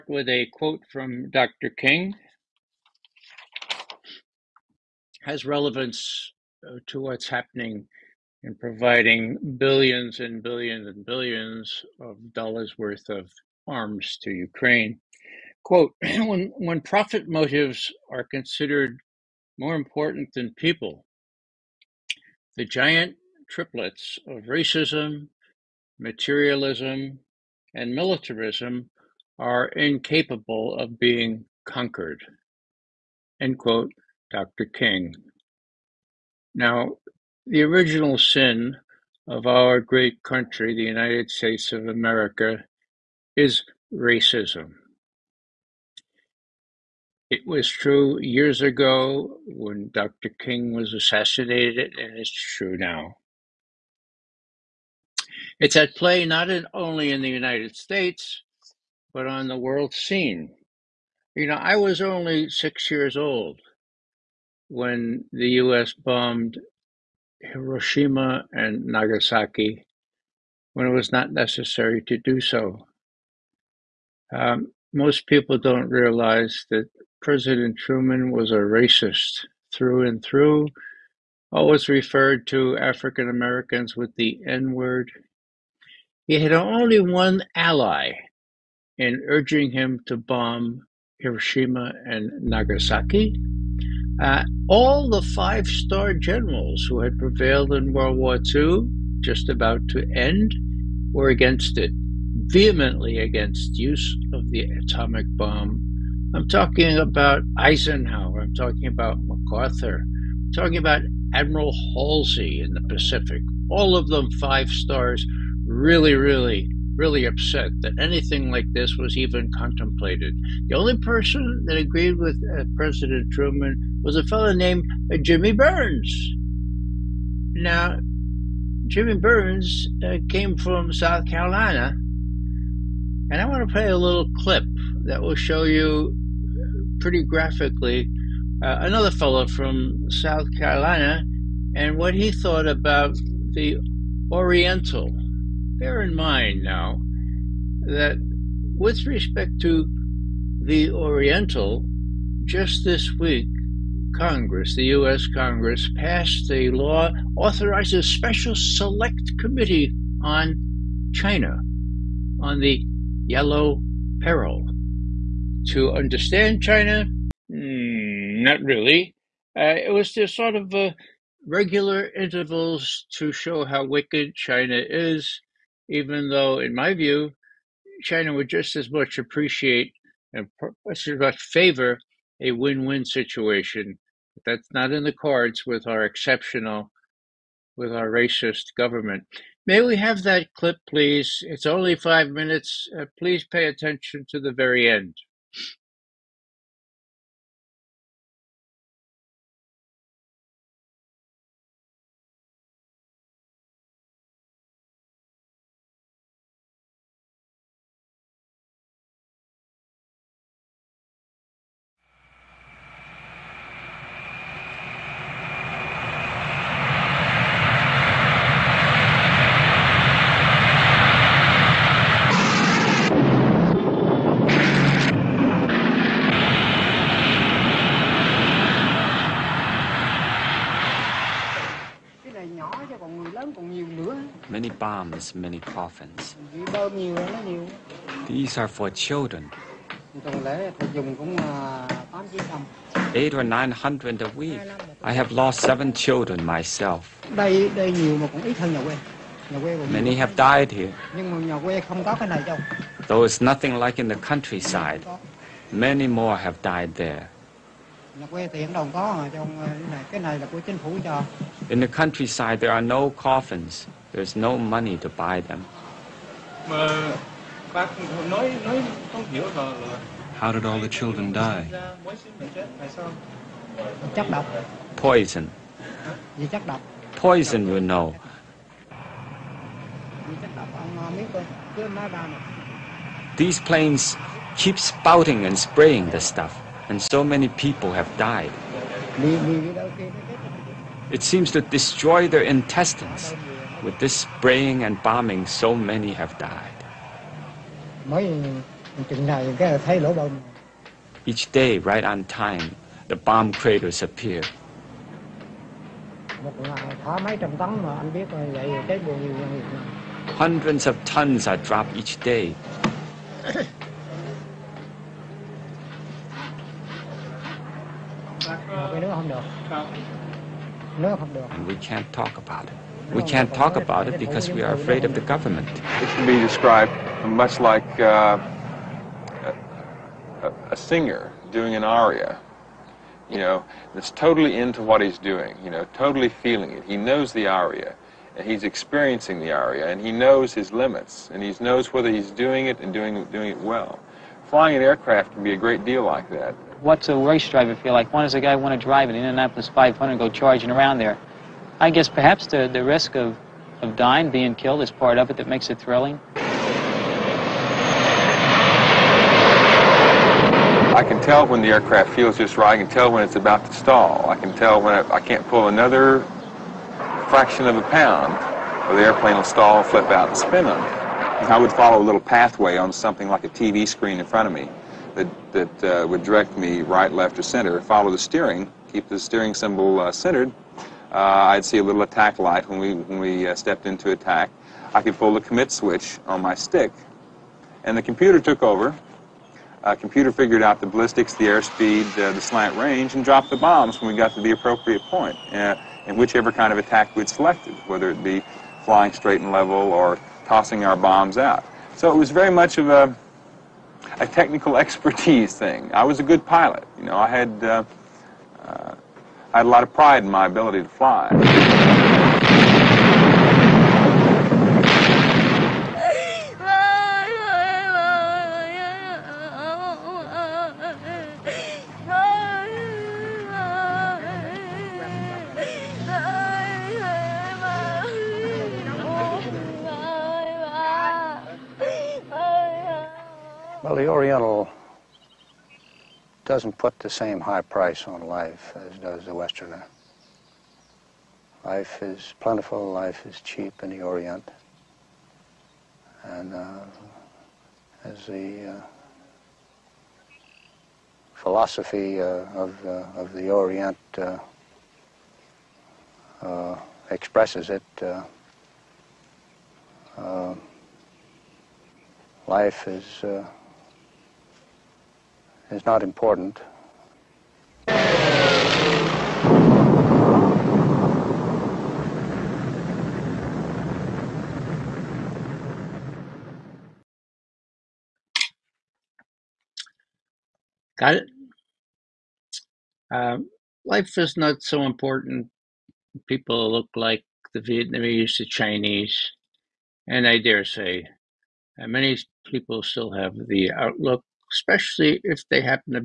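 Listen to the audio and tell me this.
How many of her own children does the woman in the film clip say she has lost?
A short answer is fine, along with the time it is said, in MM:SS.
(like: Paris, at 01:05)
7, at 04:05.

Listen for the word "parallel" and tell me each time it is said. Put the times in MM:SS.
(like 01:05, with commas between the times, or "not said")
not said.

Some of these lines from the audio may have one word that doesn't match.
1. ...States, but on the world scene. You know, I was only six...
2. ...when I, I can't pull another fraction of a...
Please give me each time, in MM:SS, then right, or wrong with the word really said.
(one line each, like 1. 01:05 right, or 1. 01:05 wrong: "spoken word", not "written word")
1. 00:57 right
2. 06:04 right.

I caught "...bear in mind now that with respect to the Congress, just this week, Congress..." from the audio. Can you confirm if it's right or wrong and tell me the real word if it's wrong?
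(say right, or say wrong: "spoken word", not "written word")
wrong: "Oriental", not "Congress".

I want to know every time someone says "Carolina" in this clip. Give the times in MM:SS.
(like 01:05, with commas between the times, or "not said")
02:11, 02:20.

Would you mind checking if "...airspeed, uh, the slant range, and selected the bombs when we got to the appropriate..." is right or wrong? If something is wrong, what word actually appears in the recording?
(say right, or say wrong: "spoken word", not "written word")
wrong: "dropped", not "selected".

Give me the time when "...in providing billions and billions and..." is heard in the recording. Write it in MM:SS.
00:08.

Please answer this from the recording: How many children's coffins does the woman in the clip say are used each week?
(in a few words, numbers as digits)
800 or 900.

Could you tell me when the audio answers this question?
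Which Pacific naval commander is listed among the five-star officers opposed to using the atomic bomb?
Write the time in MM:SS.
01:51.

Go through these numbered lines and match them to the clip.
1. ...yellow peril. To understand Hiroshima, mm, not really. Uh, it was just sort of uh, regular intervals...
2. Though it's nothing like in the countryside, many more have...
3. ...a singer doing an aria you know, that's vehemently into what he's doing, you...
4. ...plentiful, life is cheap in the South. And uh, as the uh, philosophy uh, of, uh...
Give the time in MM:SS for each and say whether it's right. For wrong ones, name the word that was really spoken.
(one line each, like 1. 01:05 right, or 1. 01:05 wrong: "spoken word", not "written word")
1. 02:43 wrong: "China", not "Hiroshima"
2. 04:13 right
3. 05:30 wrong: "totally", not "vehemently"
4. 07:22 wrong: "Orient", not "South".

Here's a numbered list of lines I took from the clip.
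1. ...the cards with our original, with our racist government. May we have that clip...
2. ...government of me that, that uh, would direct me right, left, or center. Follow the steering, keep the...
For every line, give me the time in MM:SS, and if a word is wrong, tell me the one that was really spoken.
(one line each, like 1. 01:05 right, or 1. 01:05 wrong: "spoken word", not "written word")
1. 03:05 wrong: "exceptional", not "original"
2. 06:14 wrong: "front", not "government".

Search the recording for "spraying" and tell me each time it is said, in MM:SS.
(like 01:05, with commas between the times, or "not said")
04:45, 04:54.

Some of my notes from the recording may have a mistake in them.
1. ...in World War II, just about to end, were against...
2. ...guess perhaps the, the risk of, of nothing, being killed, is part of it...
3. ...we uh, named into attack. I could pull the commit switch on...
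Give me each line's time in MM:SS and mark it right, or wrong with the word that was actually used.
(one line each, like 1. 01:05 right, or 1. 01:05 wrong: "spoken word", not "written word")
1. 01:37 right
2. 05:51 wrong: "dying", not "nothing"
3. 06:23 wrong: "stepped", not "named".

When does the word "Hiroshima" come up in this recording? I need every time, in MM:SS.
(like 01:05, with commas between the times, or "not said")
01:07, 01:31.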